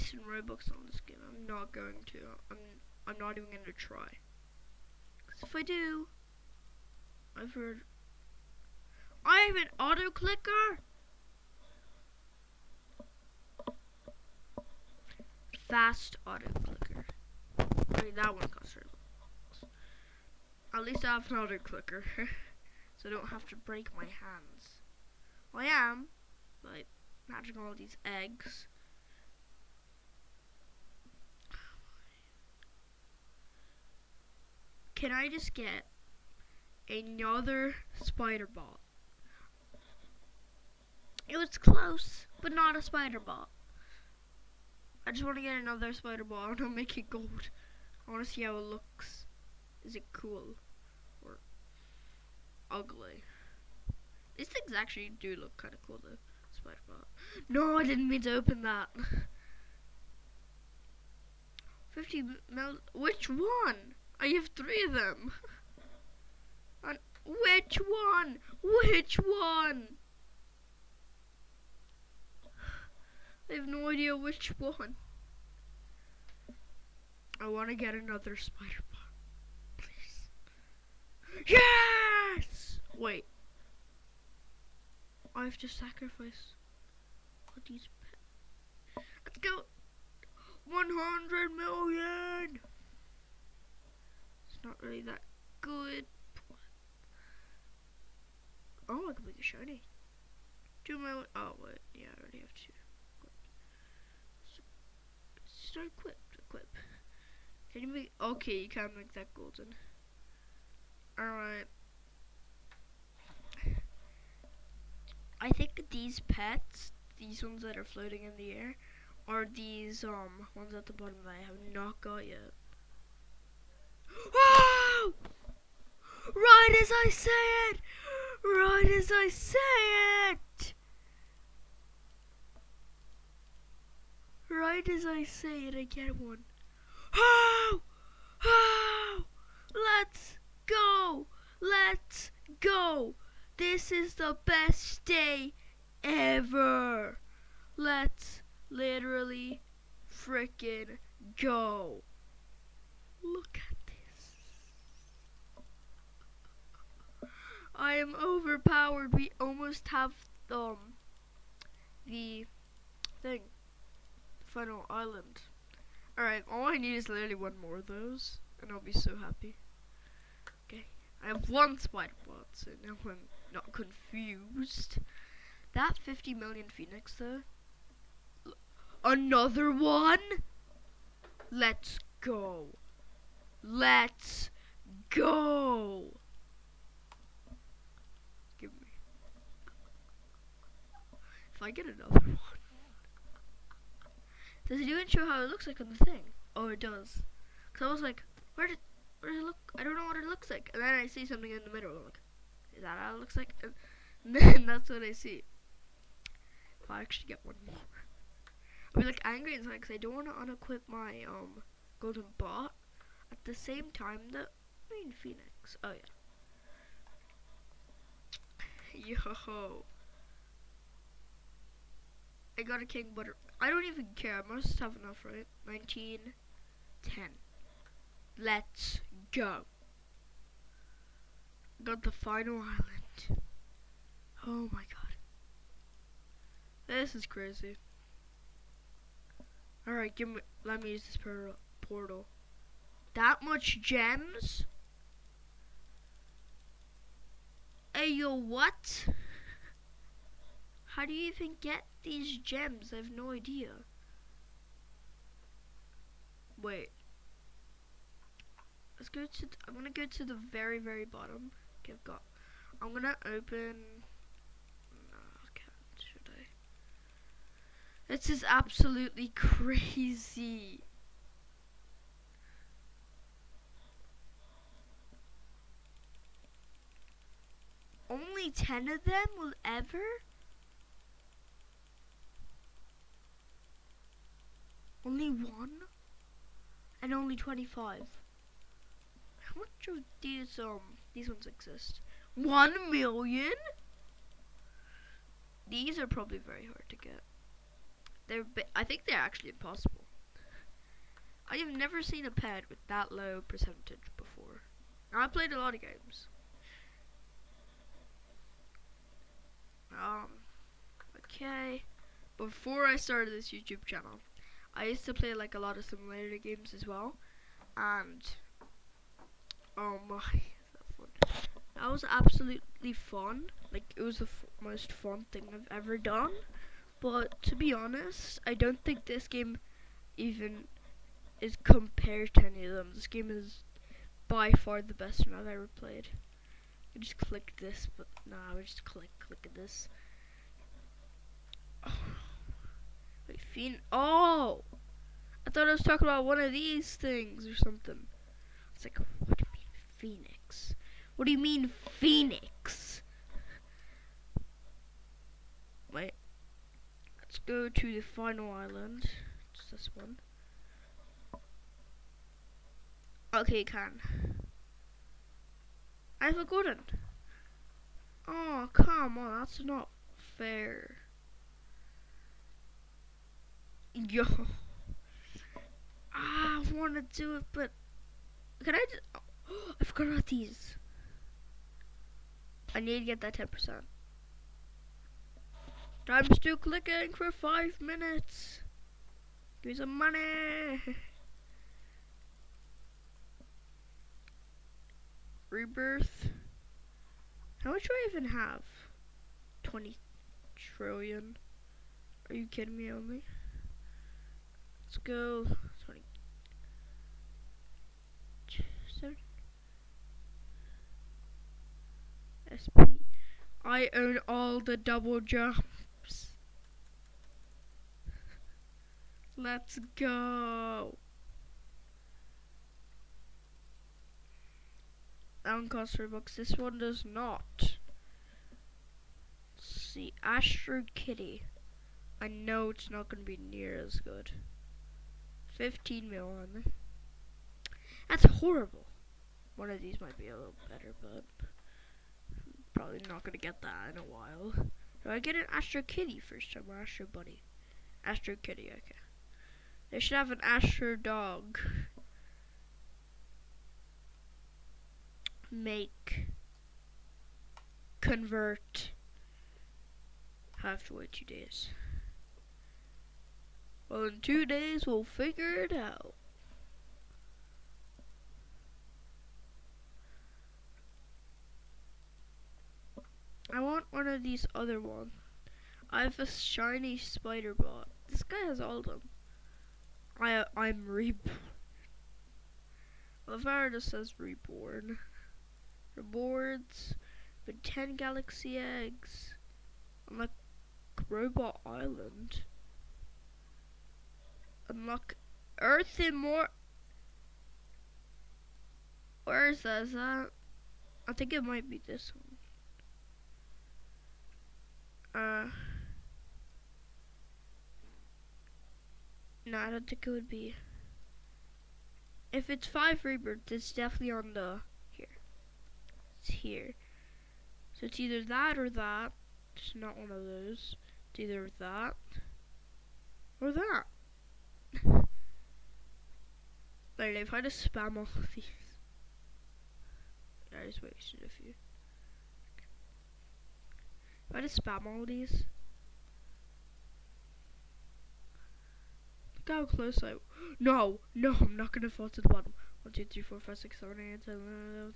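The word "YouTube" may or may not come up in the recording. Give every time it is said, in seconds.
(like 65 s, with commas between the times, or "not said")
313 s.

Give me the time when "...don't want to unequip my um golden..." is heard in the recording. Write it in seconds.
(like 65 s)
209 s.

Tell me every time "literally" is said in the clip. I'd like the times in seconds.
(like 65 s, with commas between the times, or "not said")
148 s, 167 s.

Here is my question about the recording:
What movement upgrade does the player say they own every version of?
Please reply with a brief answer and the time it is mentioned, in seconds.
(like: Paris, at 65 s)
double jumps, at 413 s.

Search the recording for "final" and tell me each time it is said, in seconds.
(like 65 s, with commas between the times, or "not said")
164 s, 232 s, 358 s.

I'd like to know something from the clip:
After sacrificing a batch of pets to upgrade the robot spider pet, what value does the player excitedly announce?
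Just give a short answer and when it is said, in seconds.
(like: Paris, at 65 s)
100 million, at 90 s.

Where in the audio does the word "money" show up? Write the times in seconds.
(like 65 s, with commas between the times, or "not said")
389 s.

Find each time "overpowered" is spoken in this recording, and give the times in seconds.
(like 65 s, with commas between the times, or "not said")
158 s.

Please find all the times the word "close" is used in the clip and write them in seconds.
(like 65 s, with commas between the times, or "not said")
41 s, 539 s.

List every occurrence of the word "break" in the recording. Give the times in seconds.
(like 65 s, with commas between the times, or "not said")
23 s.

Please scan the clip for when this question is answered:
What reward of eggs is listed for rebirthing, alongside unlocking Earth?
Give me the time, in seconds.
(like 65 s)
487 s.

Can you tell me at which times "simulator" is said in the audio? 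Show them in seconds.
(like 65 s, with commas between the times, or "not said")
315 s.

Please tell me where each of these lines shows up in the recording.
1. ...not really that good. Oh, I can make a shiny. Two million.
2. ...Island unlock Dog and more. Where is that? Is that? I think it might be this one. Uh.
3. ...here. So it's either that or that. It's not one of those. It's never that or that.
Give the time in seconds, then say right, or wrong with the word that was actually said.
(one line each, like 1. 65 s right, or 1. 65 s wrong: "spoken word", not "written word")
1. 94 s right
2. 491 s wrong: "Earth", not "Dog"
3. 516 s wrong: "either", not "never".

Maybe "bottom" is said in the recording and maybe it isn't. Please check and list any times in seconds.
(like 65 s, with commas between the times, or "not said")
120 s, 261 s, 542 s.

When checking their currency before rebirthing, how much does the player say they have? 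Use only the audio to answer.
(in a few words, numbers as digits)
20 trillion.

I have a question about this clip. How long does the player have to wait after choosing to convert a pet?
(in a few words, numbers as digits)
2 days.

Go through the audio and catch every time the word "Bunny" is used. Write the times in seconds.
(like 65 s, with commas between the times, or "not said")
447 s.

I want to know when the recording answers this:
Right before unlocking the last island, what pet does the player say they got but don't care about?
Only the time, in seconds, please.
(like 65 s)
222 s.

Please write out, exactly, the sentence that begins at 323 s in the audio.
Like it was the most fun thing I've ever done.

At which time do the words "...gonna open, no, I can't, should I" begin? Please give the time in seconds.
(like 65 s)
262 s.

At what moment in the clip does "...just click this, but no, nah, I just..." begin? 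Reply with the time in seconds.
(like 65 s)
336 s.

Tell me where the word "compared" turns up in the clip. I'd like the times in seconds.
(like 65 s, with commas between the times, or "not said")
331 s.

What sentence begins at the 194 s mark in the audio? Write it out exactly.
Does it even show how it looks like on the thing?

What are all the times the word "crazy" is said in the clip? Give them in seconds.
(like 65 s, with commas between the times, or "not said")
237 s, 269 s.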